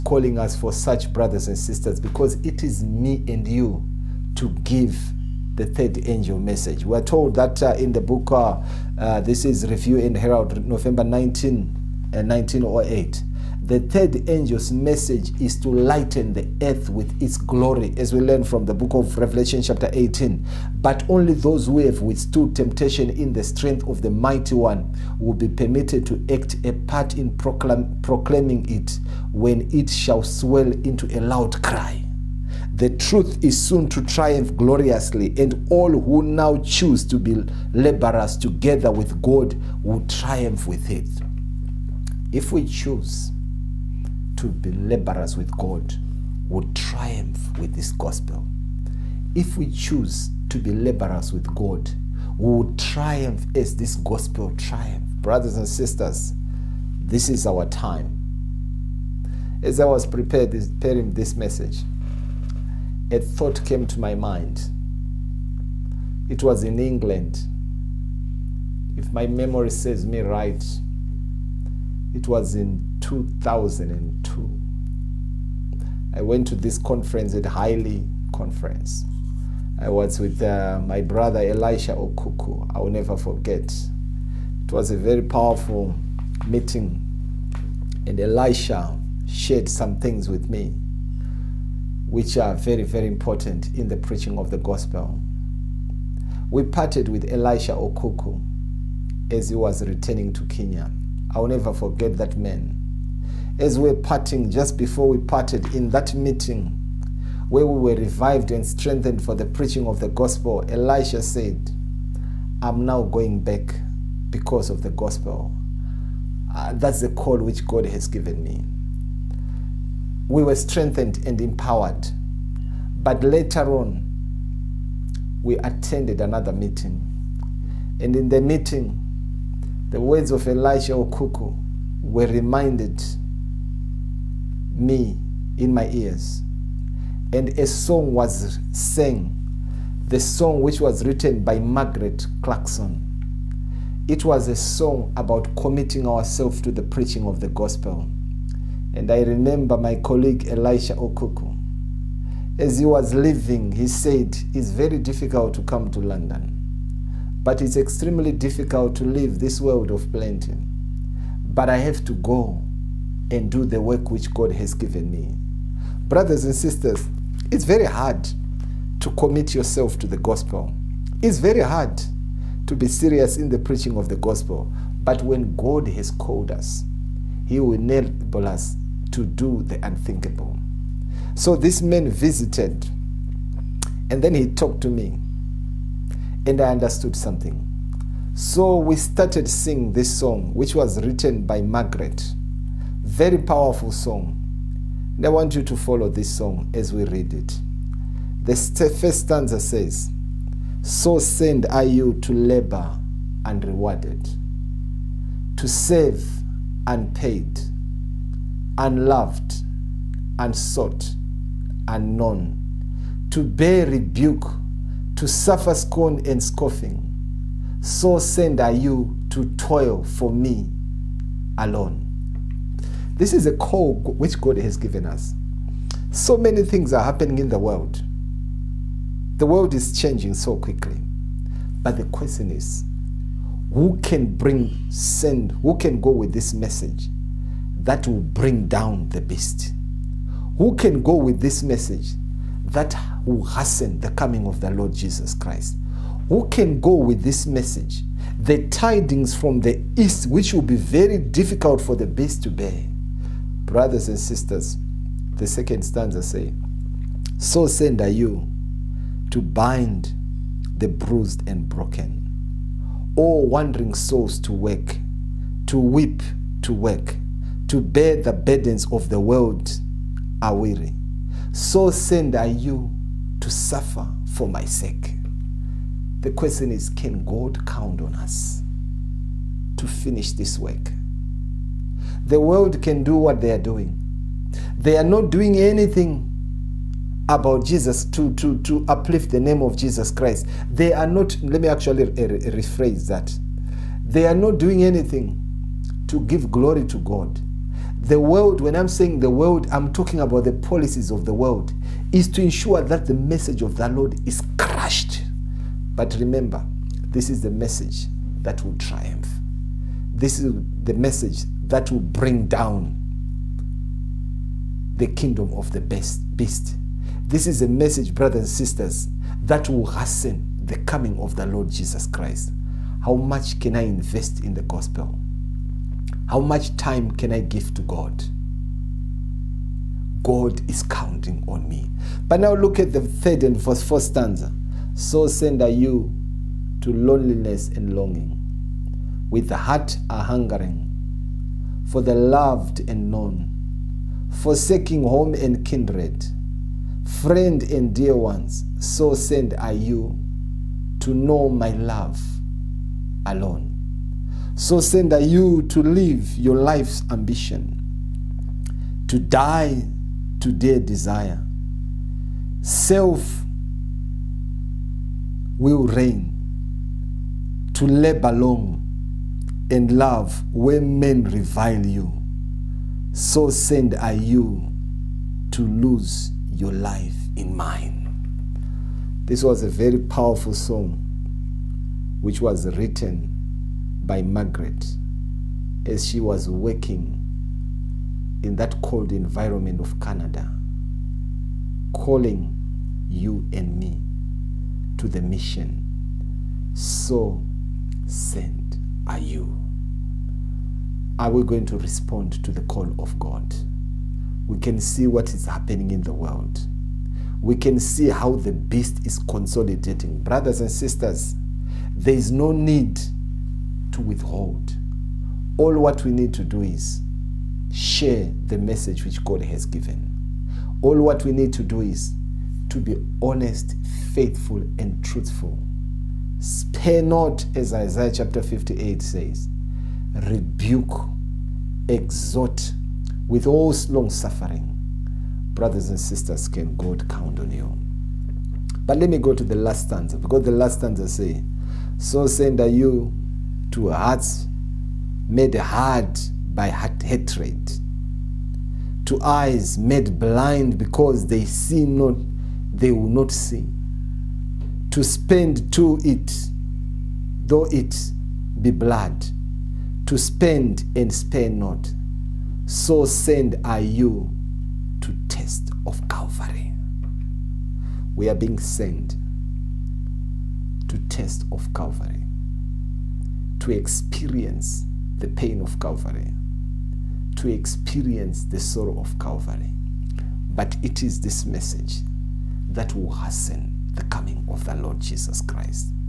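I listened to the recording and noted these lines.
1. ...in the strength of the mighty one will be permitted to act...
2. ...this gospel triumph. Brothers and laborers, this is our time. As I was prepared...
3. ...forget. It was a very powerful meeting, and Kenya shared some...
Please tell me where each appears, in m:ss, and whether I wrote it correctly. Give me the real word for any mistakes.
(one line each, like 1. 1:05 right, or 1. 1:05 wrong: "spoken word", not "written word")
1. 0:23 right
2. 0:53 wrong: "sisters", not "laborers"
3. 1:23 wrong: "Elisha", not "Kenya".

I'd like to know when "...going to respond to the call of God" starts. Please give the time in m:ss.
6:41.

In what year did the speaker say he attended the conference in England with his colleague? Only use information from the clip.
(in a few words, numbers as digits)
2002.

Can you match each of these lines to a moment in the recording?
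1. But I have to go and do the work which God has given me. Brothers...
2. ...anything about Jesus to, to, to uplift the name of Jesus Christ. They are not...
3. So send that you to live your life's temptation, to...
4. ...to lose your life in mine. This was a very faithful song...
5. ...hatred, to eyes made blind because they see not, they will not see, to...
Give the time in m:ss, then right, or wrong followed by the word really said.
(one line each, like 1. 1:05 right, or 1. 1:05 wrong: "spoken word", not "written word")
1. 2:41 right
2. 4:45 right
3. 5:54 wrong: "ambition", not "temptation"
4. 6:15 wrong: "powerful", not "faithful"
5. 7:26 right.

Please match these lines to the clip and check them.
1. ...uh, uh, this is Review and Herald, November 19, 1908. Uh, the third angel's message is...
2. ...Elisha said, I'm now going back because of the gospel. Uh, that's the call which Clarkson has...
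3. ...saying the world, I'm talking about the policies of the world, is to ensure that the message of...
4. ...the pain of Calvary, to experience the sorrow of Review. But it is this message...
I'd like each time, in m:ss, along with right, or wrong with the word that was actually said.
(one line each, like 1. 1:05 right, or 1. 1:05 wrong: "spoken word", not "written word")
1. 0:08 right
2. 1:50 wrong: "God", not "Clarkson"
3. 4:58 right
4. 7:55 wrong: "Calvary", not "Review".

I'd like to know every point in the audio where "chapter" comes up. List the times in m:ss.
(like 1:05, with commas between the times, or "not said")
0:19, 7:08.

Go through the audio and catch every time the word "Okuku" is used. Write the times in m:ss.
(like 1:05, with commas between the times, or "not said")
1:21, 1:37, 2:10, 2:30.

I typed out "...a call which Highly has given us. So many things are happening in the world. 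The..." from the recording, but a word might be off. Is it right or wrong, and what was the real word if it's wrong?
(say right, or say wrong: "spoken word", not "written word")
wrong: "God", not "Highly".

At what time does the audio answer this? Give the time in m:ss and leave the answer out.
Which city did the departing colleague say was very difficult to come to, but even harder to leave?
2:35.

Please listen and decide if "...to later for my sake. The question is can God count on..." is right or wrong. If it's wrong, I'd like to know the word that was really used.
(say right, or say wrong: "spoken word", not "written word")
wrong: "suffer", not "later".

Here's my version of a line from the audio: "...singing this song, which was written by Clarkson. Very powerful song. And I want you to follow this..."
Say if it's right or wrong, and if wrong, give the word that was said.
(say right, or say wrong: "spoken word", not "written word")
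wrong: "Margaret", not "Clarkson".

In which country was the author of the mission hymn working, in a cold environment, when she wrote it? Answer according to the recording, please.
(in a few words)
Canada.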